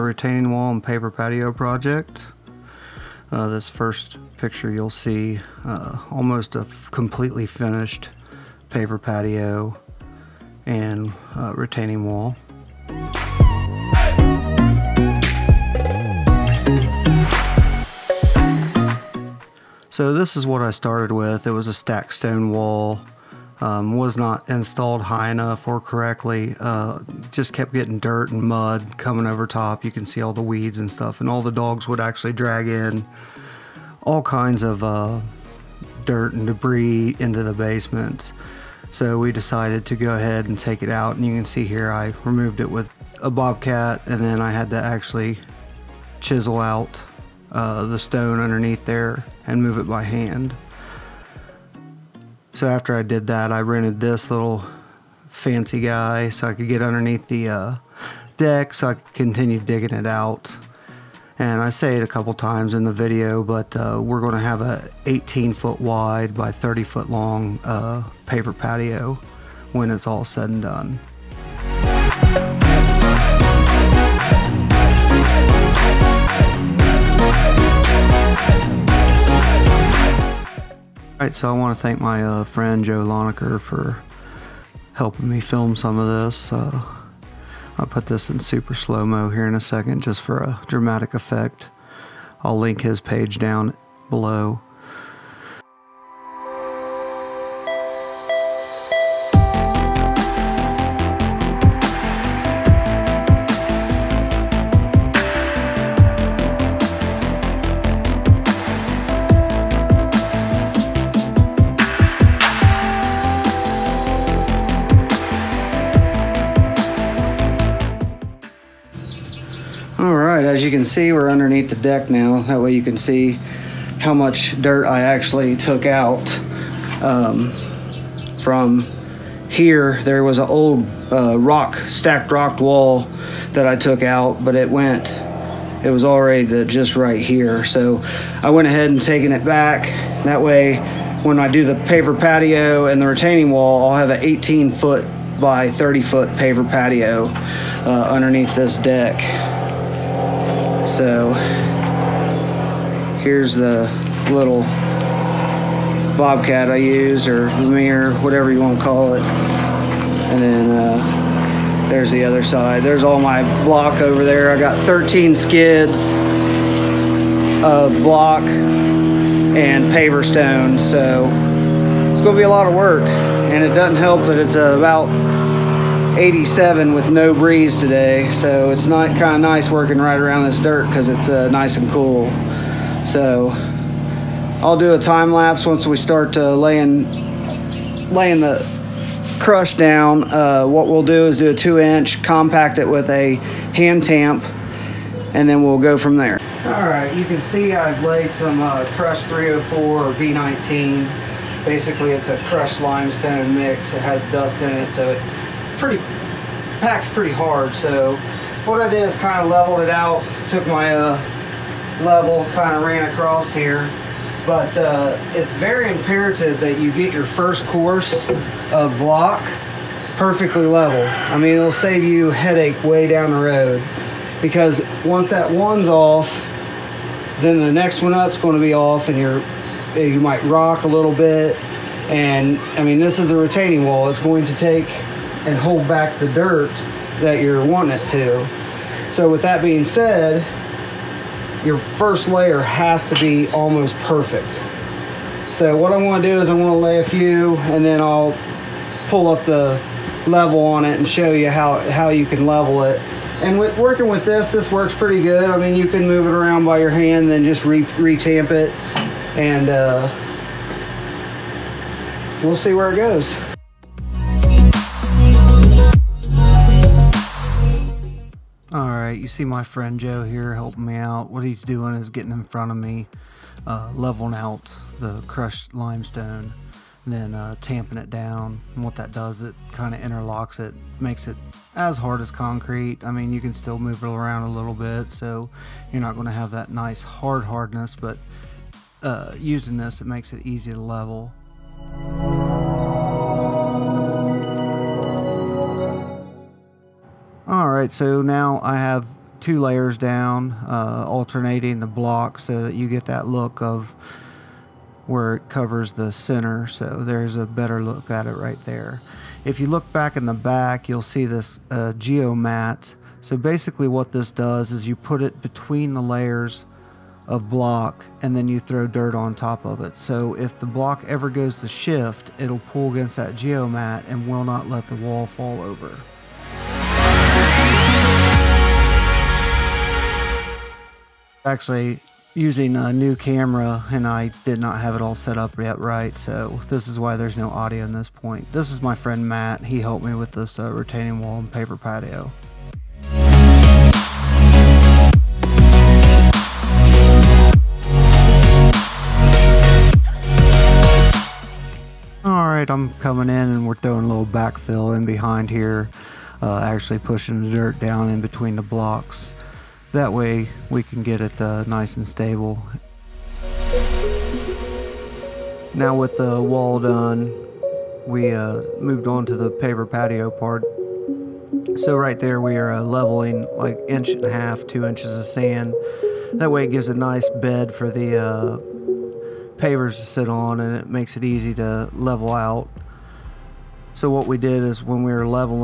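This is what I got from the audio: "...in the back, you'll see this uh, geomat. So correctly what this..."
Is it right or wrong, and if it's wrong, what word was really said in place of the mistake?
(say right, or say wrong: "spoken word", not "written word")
wrong: "basically", not "correctly".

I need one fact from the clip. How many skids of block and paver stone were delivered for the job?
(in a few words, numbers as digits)
13.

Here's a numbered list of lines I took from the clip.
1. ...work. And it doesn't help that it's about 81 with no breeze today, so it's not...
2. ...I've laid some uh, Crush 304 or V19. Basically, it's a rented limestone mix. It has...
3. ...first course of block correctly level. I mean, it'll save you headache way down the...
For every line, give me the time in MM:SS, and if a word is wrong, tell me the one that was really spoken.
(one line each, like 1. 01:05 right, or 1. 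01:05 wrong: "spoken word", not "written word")
1. 02:52 wrong: "87", not "81"
2. 03:17 wrong: "crushed", not "rented"
3. 03:37 wrong: "perfectly", not "correctly".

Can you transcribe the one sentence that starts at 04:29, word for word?
right, you see my friend Joe here helping me out.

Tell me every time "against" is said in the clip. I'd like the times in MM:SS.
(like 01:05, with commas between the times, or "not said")
05:22.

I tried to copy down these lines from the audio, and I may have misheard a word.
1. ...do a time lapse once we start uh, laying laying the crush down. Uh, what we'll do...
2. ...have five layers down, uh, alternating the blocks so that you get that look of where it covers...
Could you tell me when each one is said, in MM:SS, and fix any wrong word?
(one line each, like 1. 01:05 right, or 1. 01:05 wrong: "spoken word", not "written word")
1. 03:04 right
2. 04:58 wrong: "two", not "five".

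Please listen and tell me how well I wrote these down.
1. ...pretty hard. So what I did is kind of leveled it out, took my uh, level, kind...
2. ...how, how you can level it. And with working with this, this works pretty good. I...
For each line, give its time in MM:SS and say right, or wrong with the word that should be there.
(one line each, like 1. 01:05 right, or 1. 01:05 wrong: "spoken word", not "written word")
1. 03:27 right
2. 04:11 right.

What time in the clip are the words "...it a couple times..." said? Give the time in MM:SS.
01:01.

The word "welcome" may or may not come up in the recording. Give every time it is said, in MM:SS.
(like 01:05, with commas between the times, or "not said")
not said.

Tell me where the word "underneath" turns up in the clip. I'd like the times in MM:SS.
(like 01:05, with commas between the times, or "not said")
00:48, 00:56, 02:01, 02:28.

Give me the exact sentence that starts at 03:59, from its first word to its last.
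So with that being said, your first layer has to be almost perfect.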